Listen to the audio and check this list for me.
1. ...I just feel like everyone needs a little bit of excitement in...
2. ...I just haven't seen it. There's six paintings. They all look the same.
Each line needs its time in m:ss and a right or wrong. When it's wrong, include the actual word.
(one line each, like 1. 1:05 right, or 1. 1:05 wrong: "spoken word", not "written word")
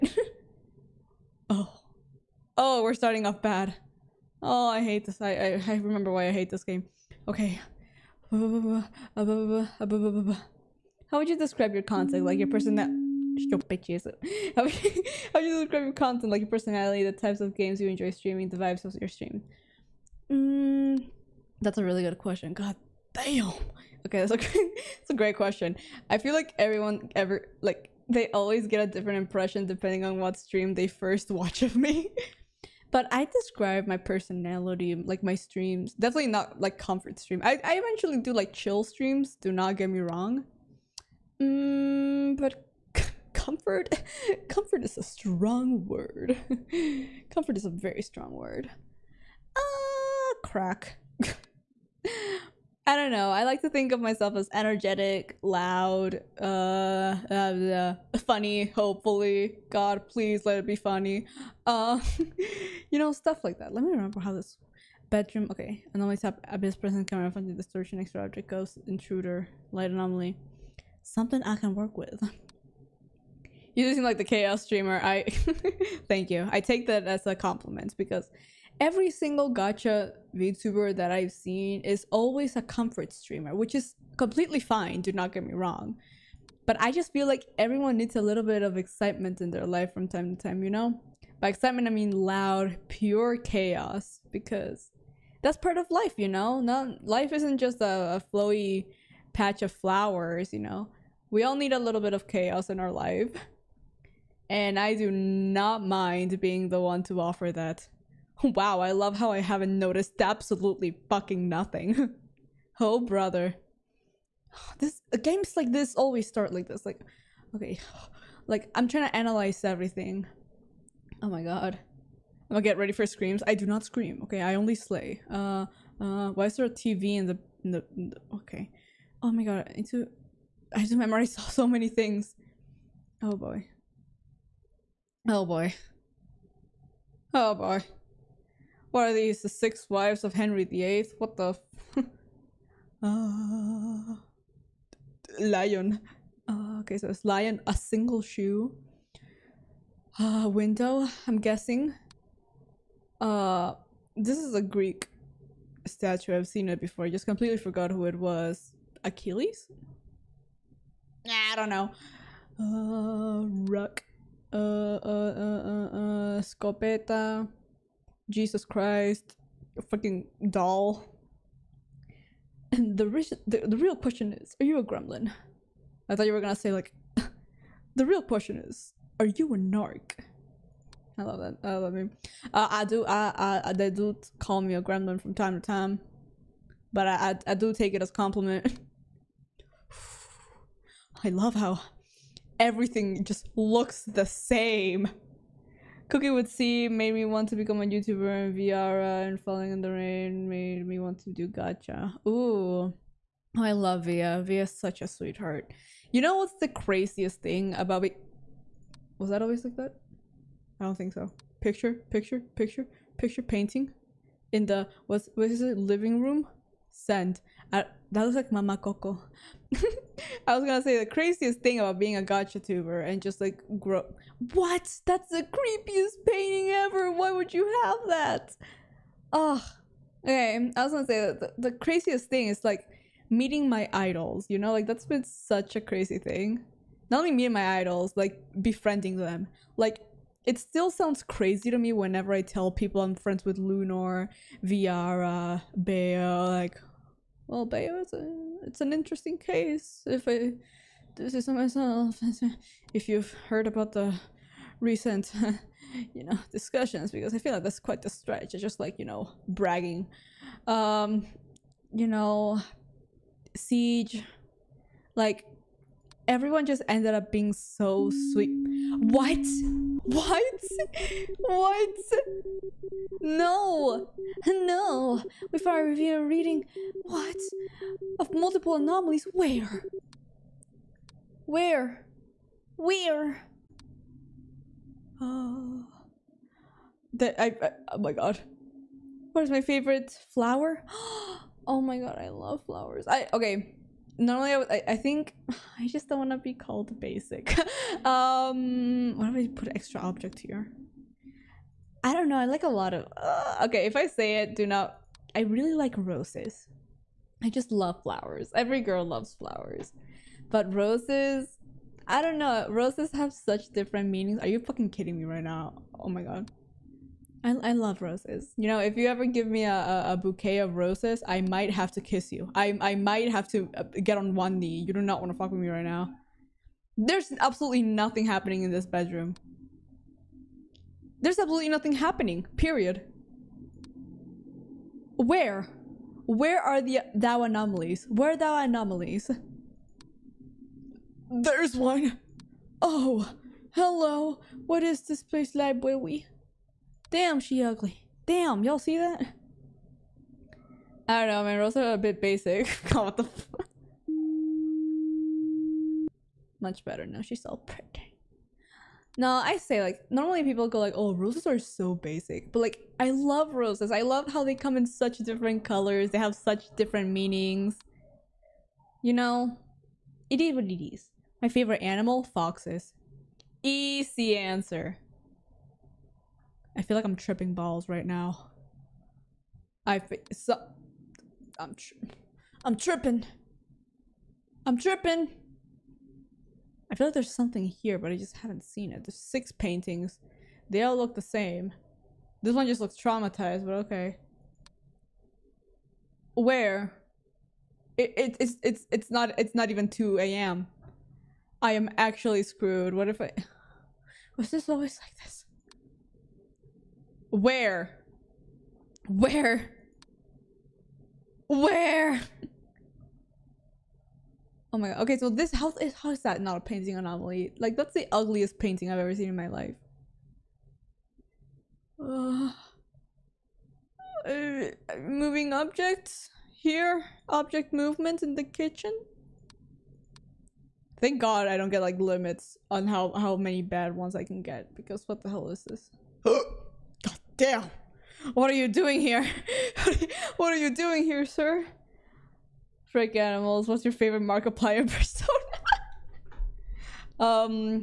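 1. 1:26 right
2. 6:28 right.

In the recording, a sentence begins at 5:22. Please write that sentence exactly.
I, I might have to uh, get on one knee.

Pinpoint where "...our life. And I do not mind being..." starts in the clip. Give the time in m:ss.
1:42.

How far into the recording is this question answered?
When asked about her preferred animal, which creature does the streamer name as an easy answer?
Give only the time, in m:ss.
6:12.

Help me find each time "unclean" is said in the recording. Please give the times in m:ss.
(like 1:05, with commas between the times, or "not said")
not said.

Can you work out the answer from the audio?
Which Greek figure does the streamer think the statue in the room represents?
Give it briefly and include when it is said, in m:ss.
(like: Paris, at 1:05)
Achilles, at 2:39.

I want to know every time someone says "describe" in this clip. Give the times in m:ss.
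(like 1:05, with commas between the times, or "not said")
0:11, 0:15, 0:33.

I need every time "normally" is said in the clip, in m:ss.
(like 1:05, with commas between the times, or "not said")
4:54, 6:00.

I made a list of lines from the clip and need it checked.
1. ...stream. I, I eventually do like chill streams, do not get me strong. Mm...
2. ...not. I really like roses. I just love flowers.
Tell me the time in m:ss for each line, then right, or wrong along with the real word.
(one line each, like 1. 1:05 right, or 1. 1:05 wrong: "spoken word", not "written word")
1. 0:37 wrong: "wrong", not "strong"
2. 5:04 right.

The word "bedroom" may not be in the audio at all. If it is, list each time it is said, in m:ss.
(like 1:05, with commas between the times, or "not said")
1:05, 5:28.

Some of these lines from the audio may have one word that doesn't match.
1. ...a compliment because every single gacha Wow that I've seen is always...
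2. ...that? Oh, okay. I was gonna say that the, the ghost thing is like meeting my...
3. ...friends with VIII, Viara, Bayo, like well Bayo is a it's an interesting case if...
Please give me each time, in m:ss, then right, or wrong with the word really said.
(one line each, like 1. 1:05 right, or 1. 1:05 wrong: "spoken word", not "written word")
1. 1:17 wrong: "VTuber", not "Wow"
2. 3:48 wrong: "craziest", not "ghost"
3. 4:03 wrong: "Lunor", not "VIII".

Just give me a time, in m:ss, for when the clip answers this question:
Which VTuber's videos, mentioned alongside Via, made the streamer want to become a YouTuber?
3:16.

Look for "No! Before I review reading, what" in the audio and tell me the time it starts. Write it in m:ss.
4:34.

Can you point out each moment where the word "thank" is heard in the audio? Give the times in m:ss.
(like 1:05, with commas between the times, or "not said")
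1:16, 7:11.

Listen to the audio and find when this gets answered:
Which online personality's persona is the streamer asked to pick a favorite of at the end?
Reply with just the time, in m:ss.
7:24.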